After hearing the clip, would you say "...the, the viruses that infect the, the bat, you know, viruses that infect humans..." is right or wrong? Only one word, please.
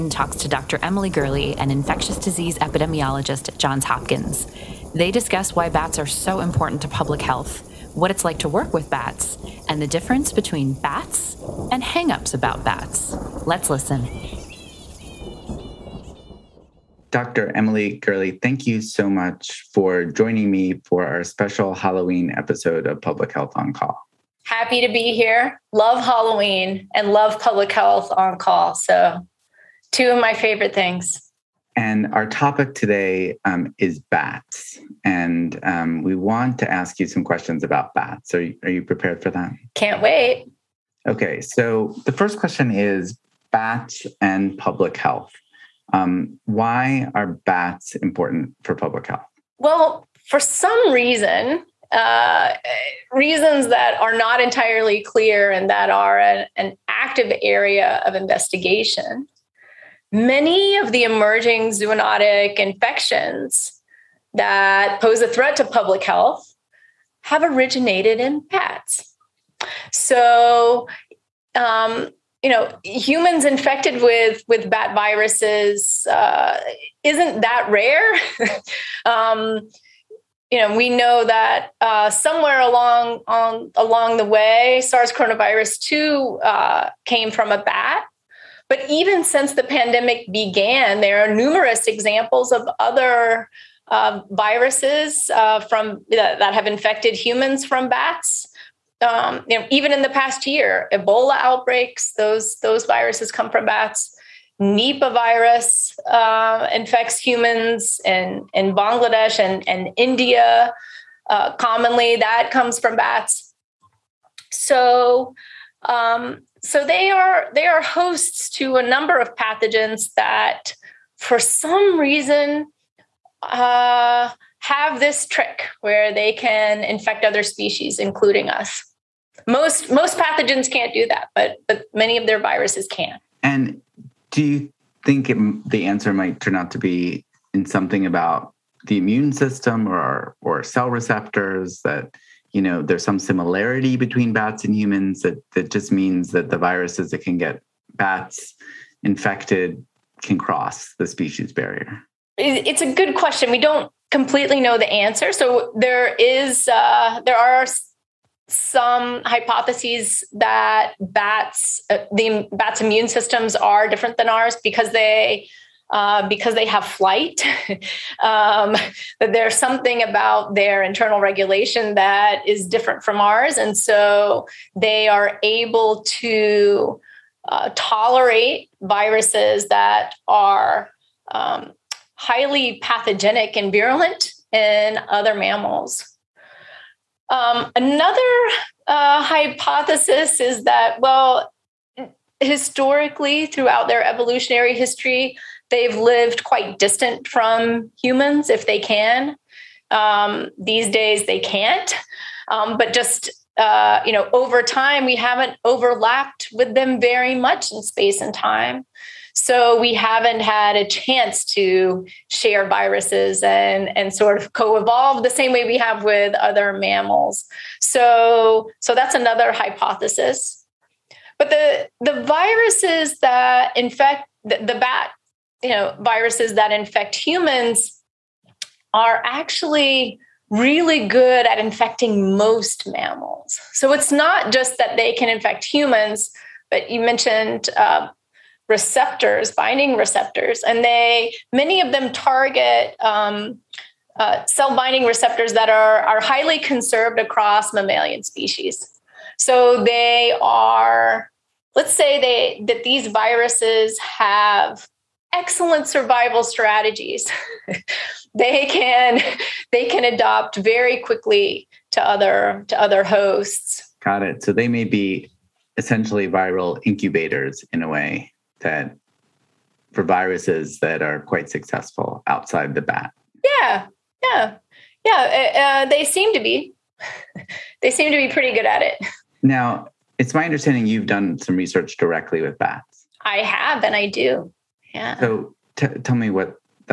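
right.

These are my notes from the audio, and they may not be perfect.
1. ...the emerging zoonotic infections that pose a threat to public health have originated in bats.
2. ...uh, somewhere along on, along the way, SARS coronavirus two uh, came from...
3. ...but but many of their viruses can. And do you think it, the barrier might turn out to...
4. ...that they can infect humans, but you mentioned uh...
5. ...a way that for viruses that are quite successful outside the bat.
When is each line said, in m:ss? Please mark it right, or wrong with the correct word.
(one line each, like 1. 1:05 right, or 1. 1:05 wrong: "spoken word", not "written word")
1. 1:00 right
2. 1:21 right
3. 2:11 wrong: "answer", not "barrier"
4. 3:54 right
5. 4:27 right.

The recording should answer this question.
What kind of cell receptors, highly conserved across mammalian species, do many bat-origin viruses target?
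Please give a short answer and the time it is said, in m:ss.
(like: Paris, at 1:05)
Cell binding receptors, at 4:04.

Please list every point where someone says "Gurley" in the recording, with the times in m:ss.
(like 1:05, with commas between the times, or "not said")
0:01, 0:17.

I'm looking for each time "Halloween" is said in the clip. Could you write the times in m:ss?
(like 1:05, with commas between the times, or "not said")
0:21, 0:26.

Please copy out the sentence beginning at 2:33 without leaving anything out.
We don't completely know the answer.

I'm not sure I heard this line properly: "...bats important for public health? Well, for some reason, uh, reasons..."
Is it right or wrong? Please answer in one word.
right.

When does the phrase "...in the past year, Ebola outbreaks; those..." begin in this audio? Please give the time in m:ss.
1:39.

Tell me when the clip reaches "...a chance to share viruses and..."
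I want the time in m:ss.
3:30.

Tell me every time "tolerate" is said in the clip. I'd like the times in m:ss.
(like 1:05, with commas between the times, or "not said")
2:57.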